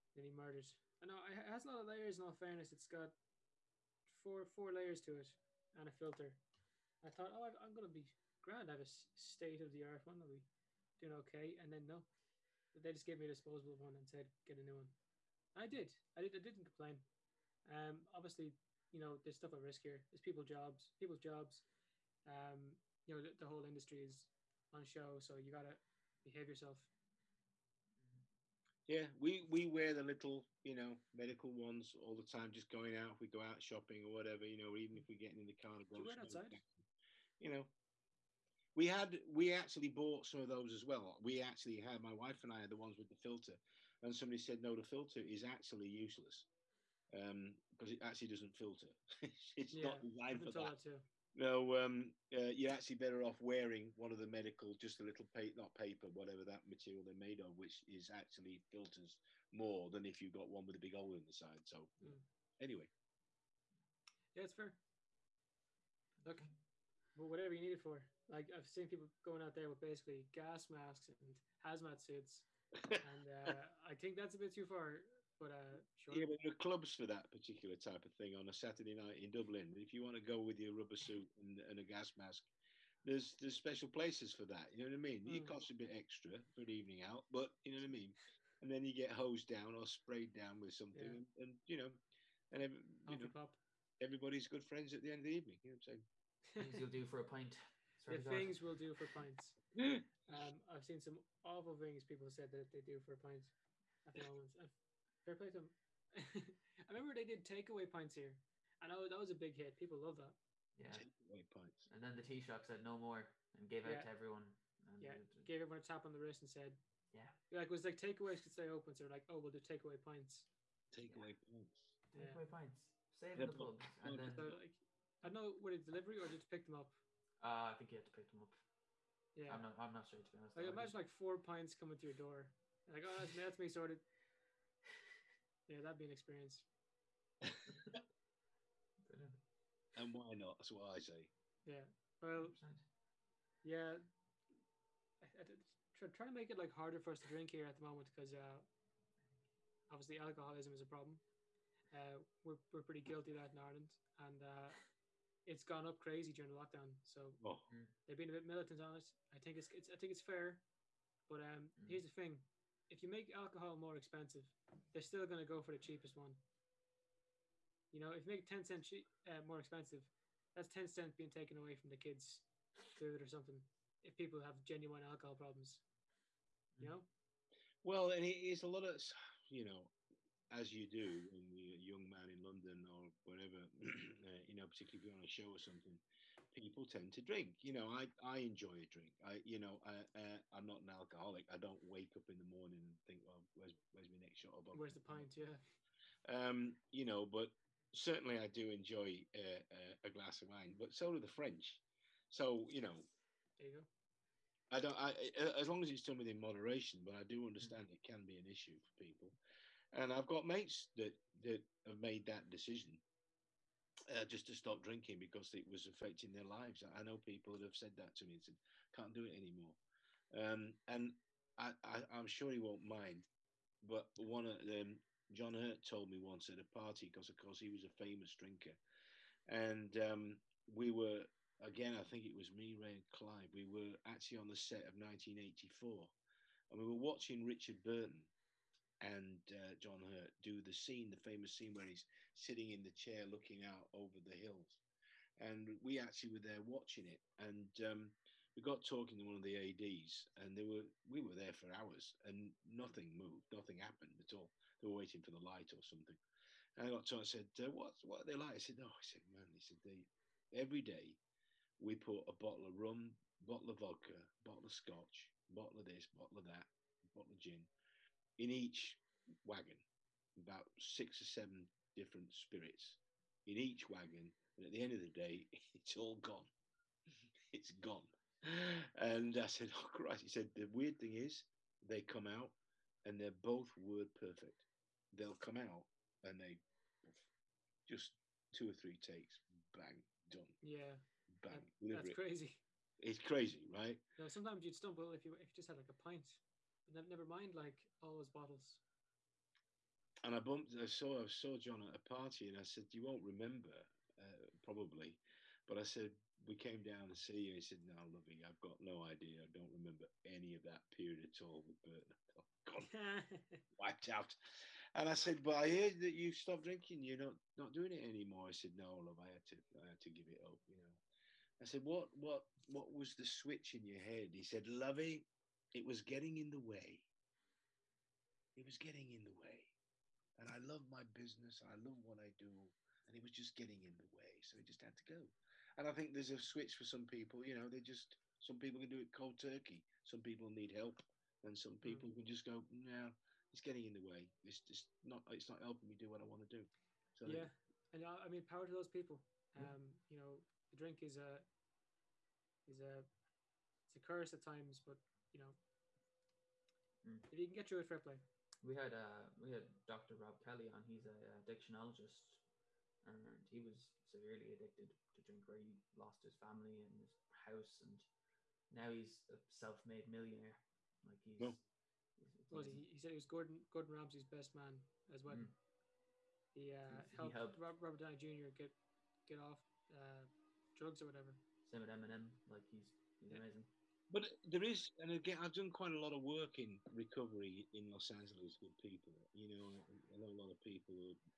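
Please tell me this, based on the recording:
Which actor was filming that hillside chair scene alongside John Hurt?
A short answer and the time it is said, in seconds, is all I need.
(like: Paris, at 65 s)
Richard Burton, at 237 s.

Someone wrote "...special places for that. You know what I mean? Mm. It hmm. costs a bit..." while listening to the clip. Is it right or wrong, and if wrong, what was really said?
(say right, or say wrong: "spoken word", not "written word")
right.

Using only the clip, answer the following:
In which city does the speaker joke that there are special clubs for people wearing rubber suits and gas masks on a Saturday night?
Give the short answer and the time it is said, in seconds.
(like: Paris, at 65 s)
Dublin, at 79 s.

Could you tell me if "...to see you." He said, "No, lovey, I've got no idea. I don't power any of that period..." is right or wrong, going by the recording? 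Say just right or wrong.
wrong.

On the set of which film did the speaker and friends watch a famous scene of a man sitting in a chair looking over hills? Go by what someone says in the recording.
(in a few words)
1984.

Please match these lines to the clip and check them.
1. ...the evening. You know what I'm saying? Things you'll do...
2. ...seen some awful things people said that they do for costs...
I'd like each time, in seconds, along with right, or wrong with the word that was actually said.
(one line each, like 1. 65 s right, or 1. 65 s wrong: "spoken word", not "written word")
1. 95 s right
2. 100 s wrong: "pints", not "costs".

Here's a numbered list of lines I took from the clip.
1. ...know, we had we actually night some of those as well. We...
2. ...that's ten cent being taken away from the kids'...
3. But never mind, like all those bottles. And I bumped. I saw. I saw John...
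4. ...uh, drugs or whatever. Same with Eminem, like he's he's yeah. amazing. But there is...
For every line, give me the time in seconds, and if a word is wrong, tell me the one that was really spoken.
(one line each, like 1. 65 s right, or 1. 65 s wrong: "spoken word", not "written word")
1. 37 s wrong: "bought", not "night"
2. 170 s right
3. 296 s right
4. 379 s right.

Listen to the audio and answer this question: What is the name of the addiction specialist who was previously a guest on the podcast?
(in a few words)
Dr. Rob Kelly.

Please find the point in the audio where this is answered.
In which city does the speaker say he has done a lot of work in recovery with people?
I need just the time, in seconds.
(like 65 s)
387 s.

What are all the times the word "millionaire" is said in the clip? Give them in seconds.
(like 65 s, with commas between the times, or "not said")
370 s.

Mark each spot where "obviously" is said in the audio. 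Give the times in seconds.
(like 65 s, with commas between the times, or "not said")
18 s, 149 s.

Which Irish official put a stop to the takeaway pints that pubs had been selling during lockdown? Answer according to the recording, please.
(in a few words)
Taoiseach.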